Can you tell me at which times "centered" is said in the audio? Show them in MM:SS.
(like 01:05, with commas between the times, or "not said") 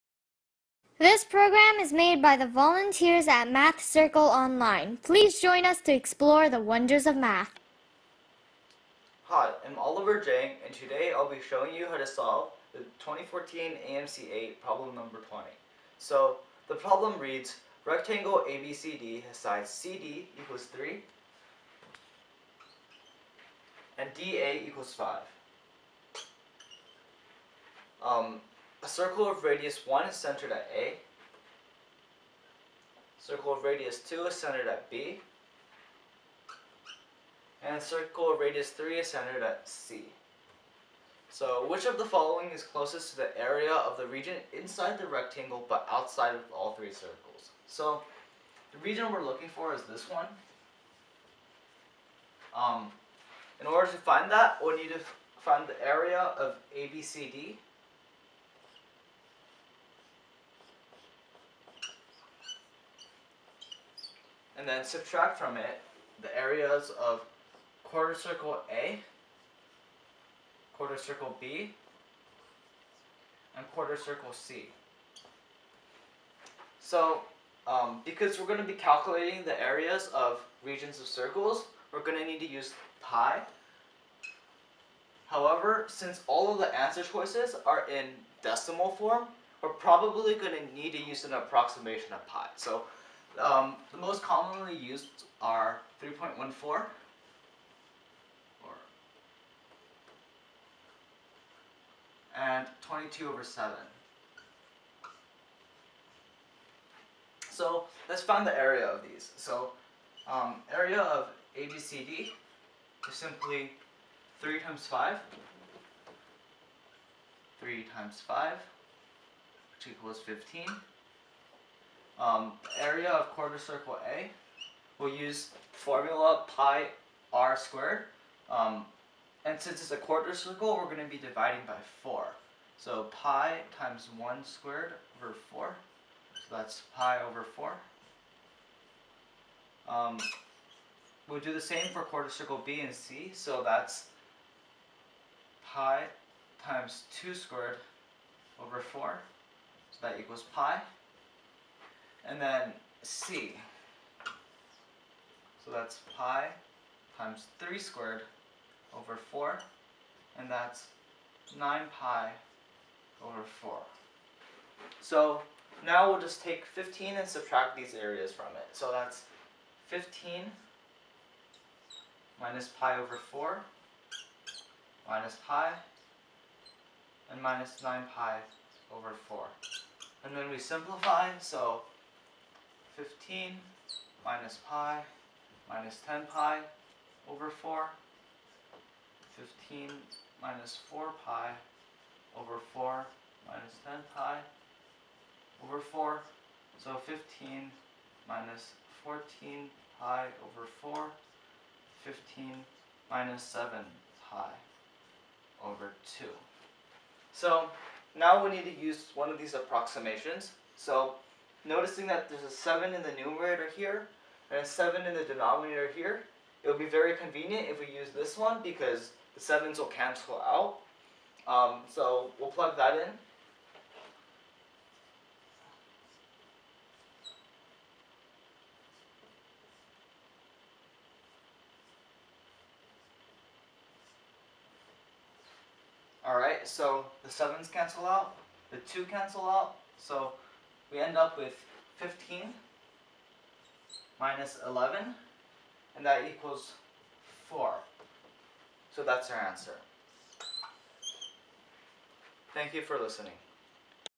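00:30, 00:34, 00:39.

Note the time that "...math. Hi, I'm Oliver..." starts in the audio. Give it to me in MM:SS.
00:07.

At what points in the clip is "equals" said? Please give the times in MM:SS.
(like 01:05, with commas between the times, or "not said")
00:20, 00:24, 01:59, 02:30, 04:06.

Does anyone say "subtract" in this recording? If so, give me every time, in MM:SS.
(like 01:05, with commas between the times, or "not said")
01:04, 02:47.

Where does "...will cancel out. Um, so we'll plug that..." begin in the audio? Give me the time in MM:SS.
03:39.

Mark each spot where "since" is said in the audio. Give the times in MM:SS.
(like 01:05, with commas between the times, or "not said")
01:25, 02:09.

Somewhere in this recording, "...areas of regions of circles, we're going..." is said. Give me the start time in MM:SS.
01:19.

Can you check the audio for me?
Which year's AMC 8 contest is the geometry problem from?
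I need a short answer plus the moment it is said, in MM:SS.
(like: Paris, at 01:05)
2014, at 00:12.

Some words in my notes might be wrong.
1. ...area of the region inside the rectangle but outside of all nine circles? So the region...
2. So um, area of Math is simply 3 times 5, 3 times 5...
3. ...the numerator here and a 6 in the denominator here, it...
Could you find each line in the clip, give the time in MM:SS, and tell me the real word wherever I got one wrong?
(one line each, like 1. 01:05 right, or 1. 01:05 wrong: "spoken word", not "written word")
1. 00:43 wrong: "three", not "nine"
2. 01:49 wrong: "ABCD", not "Math"
3. 03:33 wrong: "7", not "6".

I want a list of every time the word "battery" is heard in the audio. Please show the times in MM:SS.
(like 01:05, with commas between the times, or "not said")
not said.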